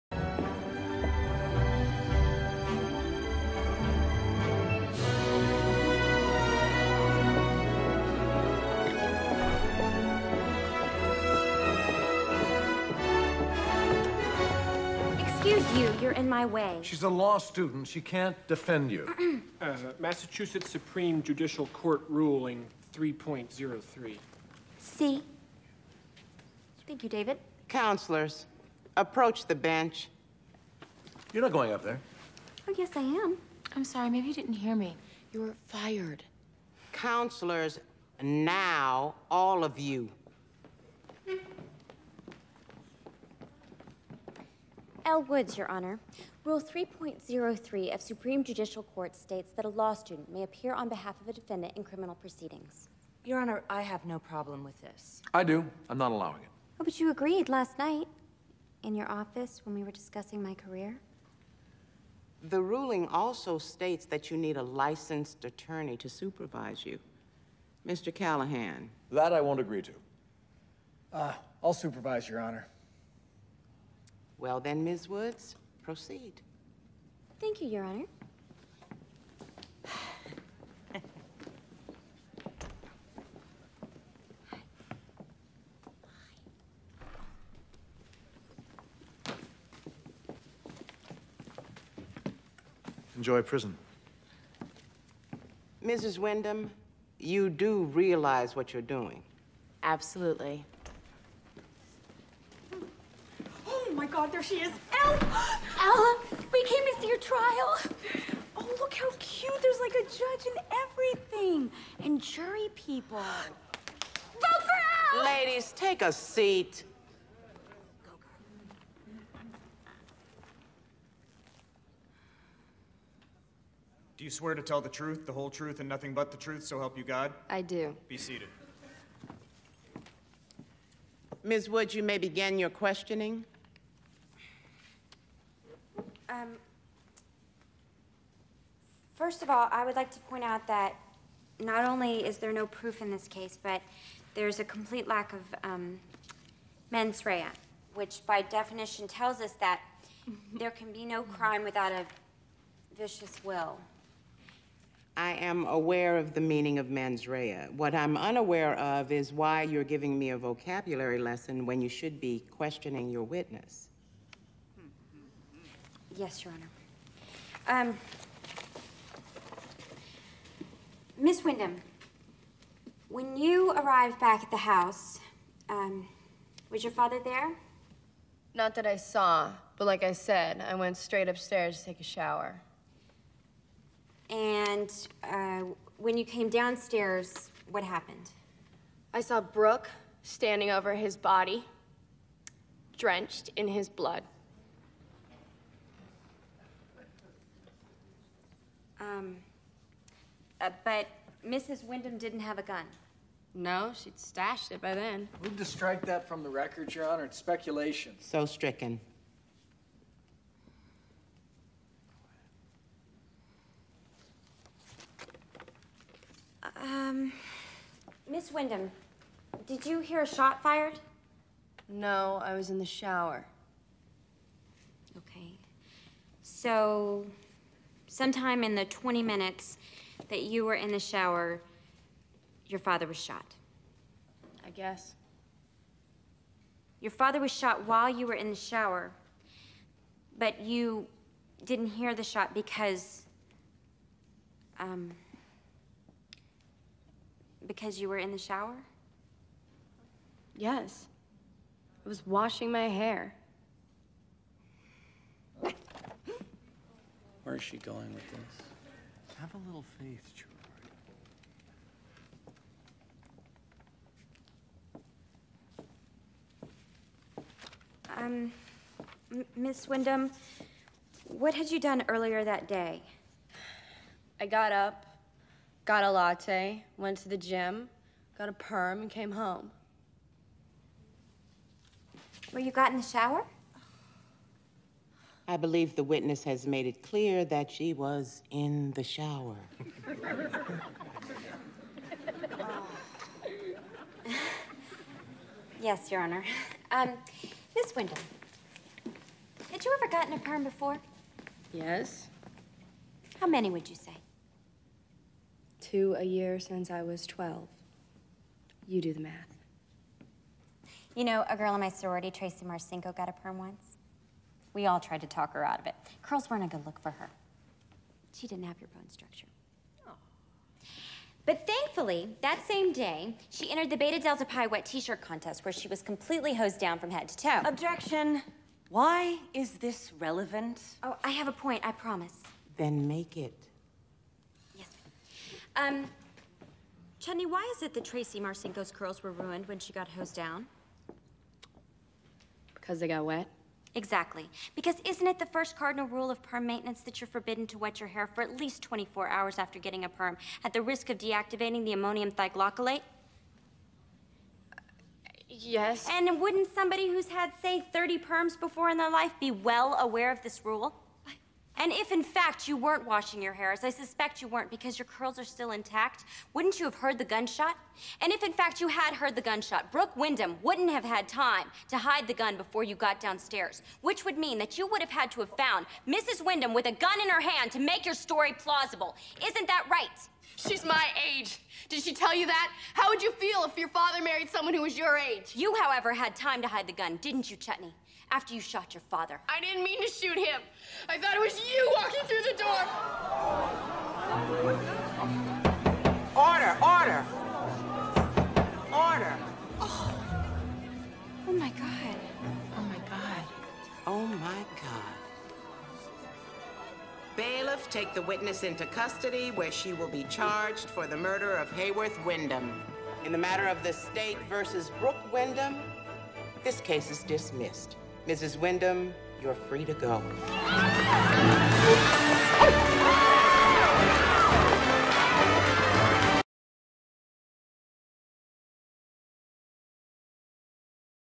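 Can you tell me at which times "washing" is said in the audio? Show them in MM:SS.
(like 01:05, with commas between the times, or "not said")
04:12, 06:03.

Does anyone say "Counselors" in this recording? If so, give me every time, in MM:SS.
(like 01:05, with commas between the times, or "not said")
00:27, 00:36.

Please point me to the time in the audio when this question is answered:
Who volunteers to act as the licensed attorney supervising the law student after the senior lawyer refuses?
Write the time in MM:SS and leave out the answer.
00:27.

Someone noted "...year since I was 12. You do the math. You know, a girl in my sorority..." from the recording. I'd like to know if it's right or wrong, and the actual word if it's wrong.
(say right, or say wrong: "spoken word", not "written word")
right.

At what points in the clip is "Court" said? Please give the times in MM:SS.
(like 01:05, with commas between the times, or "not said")
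00:21, 00:48.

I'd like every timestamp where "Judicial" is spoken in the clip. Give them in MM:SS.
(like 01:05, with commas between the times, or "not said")
00:21, 00:48.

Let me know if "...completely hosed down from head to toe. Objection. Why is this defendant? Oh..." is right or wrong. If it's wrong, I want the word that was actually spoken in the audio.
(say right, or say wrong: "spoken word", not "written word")
wrong: "relevant", not "defendant".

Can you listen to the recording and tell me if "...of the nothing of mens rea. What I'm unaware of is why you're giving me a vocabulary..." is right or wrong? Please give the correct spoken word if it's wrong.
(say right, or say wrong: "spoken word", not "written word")
wrong: "meaning", not "nothing".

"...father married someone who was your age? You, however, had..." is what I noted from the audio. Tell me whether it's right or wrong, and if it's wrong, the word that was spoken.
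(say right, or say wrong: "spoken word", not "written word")
right.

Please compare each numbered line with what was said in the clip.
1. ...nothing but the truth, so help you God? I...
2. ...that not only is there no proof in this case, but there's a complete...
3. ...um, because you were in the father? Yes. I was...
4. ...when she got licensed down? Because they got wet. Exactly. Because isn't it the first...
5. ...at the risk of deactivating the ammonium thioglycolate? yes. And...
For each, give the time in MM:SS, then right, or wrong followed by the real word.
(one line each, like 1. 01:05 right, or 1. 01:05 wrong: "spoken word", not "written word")
1. 02:05 right
2. 02:20 right
3. 04:04 wrong: "shower", not "father"
4. 05:39 wrong: "hosed", not "licensed"
5. 05:50 right.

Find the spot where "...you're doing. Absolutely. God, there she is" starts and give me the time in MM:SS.
01:38.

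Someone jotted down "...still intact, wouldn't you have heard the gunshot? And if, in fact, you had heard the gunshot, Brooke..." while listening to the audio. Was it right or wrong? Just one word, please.
right.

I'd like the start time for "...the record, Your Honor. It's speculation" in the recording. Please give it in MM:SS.
03:26.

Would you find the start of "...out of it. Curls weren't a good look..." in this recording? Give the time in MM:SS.
05:15.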